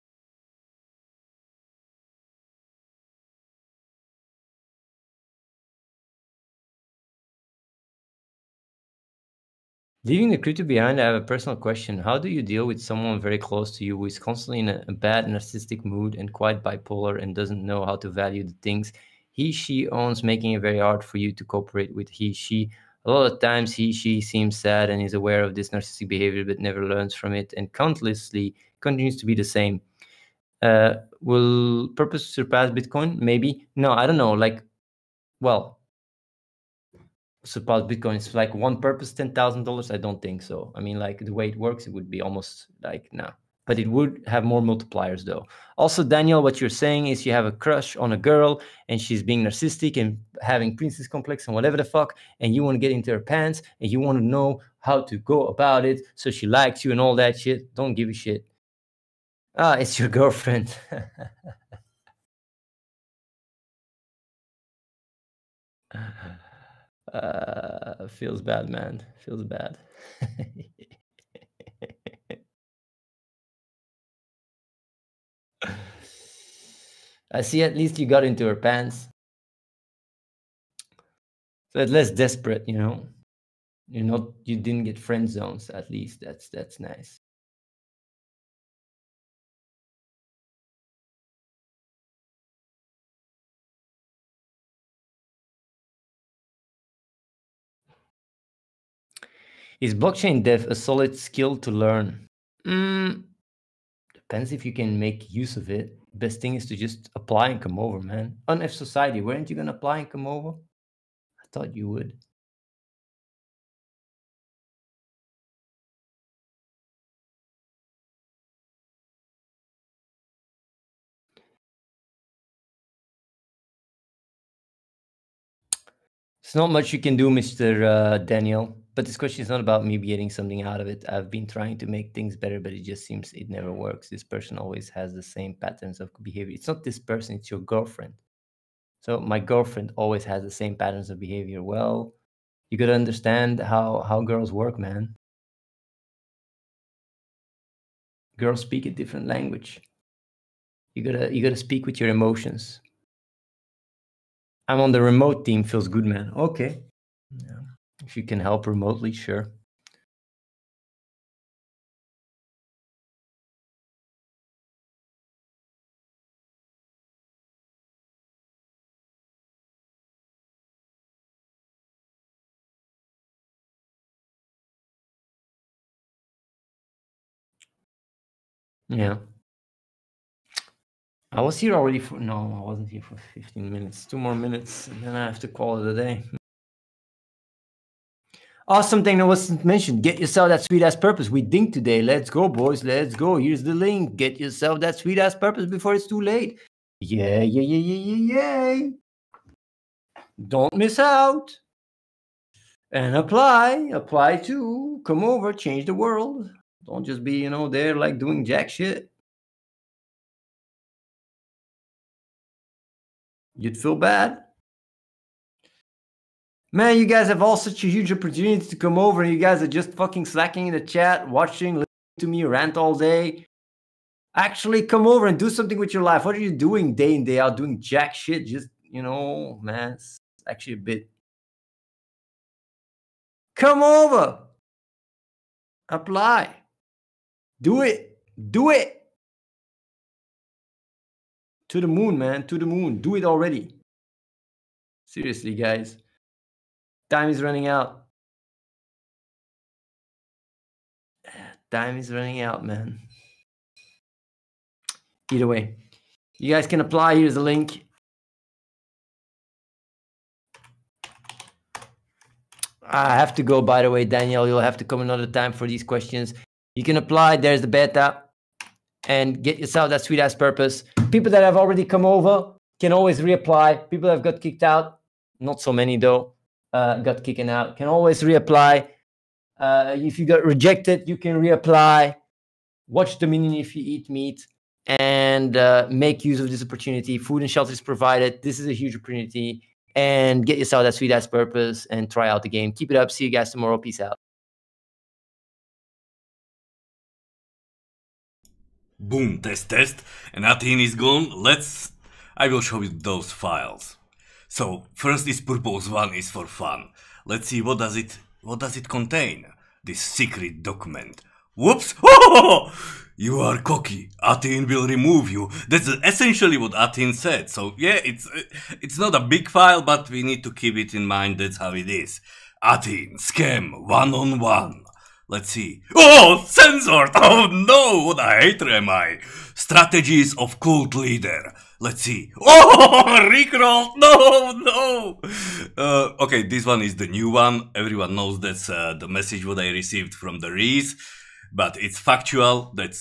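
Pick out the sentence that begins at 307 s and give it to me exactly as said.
Let's see what does it what does it contain?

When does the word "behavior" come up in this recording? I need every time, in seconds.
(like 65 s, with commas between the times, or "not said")
26 s, 136 s, 141 s.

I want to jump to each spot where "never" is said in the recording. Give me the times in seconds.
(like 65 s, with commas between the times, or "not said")
26 s, 133 s.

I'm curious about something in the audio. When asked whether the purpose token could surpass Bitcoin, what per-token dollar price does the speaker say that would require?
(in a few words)
$10,000.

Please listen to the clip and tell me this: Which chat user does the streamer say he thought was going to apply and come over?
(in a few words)
F Society.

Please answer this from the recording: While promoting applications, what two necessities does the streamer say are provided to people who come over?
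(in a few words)
food and shelter.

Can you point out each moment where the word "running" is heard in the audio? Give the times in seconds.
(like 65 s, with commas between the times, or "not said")
247 s, 252 s.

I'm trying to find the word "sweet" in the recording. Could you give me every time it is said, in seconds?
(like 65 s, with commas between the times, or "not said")
190 s, 194 s, 270 s, 290 s.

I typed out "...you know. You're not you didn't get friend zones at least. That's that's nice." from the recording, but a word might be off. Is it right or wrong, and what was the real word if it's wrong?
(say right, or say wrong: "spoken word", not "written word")
right.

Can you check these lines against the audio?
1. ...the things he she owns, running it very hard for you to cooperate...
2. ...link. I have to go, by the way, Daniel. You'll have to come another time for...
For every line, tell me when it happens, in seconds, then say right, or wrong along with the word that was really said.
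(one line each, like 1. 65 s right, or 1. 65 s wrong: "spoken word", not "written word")
1. 18 s wrong: "making", not "running"
2. 257 s right.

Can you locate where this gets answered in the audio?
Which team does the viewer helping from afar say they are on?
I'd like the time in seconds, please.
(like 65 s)
155 s.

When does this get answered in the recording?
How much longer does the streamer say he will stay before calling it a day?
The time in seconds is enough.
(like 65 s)
184 s.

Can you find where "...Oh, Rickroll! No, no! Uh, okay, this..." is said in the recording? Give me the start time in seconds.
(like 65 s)
332 s.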